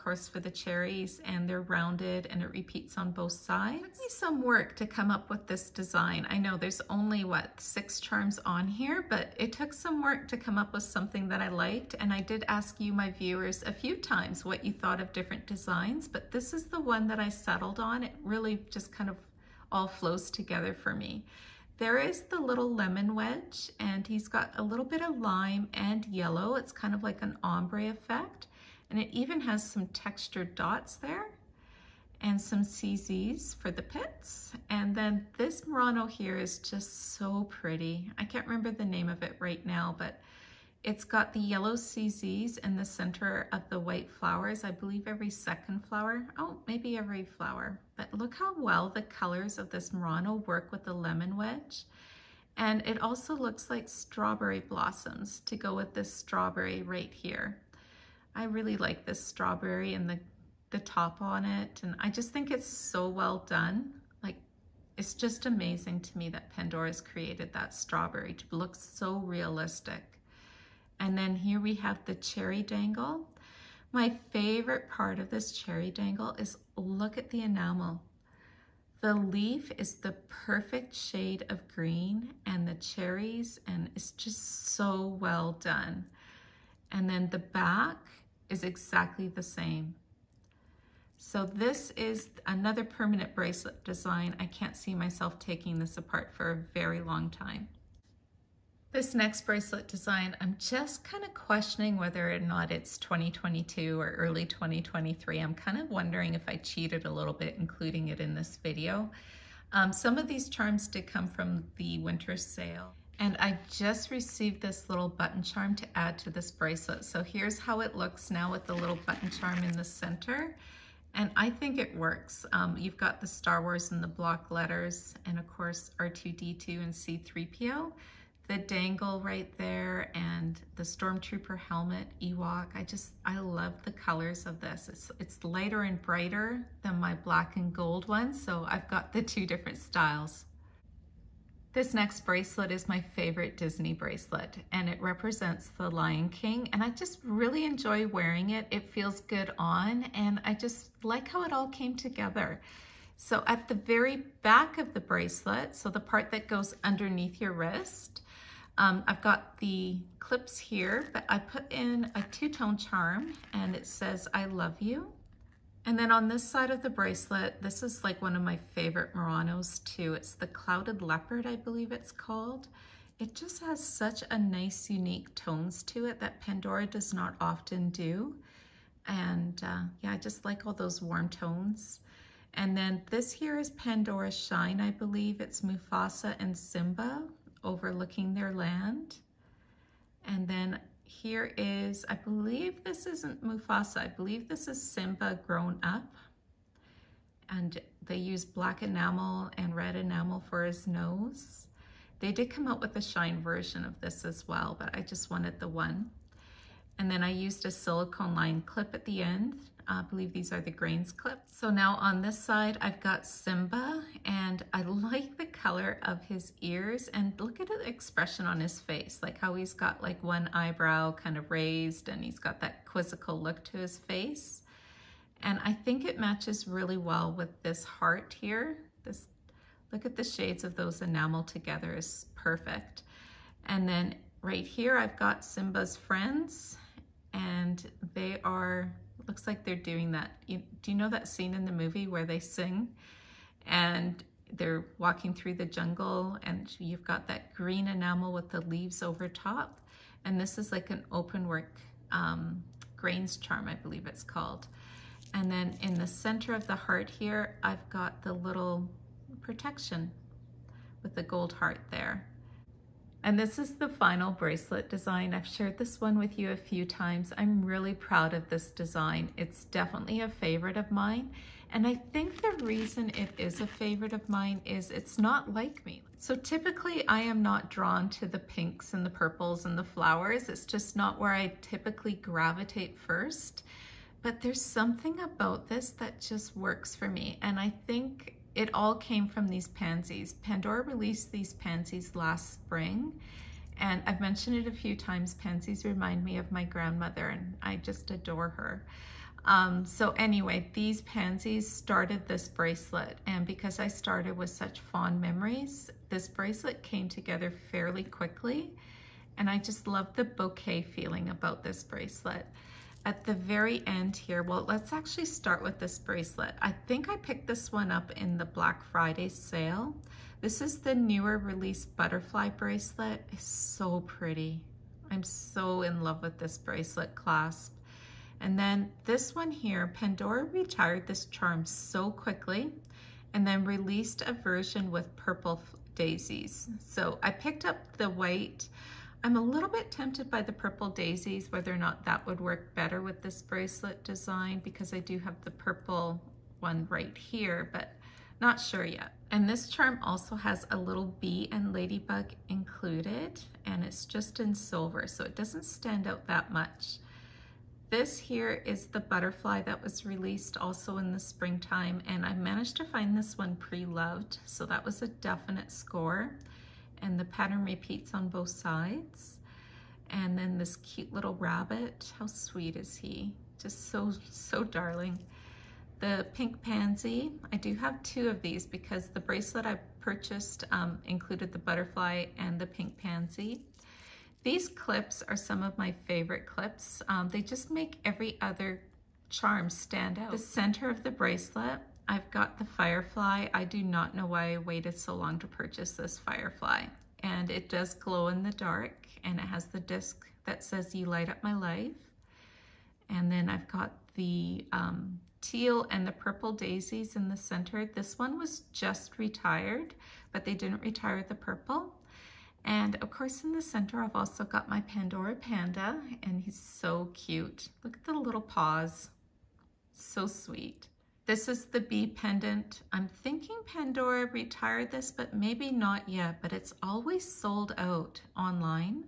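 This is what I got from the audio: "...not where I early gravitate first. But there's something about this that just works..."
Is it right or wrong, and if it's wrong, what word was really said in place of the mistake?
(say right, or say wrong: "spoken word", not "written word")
wrong: "typically", not "early".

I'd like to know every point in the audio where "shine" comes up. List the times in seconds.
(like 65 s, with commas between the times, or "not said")
184 s, 203 s.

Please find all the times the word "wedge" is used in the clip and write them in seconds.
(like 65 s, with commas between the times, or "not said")
23 s, 51 s.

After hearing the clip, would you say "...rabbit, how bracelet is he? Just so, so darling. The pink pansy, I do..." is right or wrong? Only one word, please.
wrong.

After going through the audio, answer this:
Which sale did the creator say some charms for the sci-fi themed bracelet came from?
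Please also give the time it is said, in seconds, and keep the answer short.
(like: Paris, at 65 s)
Winter sale, at 111 s.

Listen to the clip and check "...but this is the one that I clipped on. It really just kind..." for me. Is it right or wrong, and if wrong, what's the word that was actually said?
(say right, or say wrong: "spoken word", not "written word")
wrong: "settled", not "clipped".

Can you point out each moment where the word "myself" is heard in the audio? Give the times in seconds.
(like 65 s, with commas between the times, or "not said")
94 s.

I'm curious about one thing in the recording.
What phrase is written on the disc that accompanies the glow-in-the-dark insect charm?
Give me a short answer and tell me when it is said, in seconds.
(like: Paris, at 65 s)
You Light Up My Life, at 400 s.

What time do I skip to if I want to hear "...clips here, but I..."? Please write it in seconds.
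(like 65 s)
160 s.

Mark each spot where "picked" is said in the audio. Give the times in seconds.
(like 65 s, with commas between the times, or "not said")
317 s, 337 s.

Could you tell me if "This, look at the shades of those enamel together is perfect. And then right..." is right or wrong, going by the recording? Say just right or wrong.
right.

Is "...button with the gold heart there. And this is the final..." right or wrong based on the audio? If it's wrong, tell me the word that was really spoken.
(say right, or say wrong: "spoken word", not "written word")
wrong: "protection", not "button".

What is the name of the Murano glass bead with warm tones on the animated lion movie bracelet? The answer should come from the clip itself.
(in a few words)
Clouded Leopard.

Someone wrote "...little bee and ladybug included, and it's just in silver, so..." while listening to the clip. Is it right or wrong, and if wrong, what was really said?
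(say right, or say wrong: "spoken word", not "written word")
right.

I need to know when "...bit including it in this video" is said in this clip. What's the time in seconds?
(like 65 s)
107 s.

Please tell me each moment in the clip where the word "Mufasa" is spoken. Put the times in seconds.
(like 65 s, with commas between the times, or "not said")
185 s, 193 s.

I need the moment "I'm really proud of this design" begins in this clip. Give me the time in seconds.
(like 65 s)
267 s.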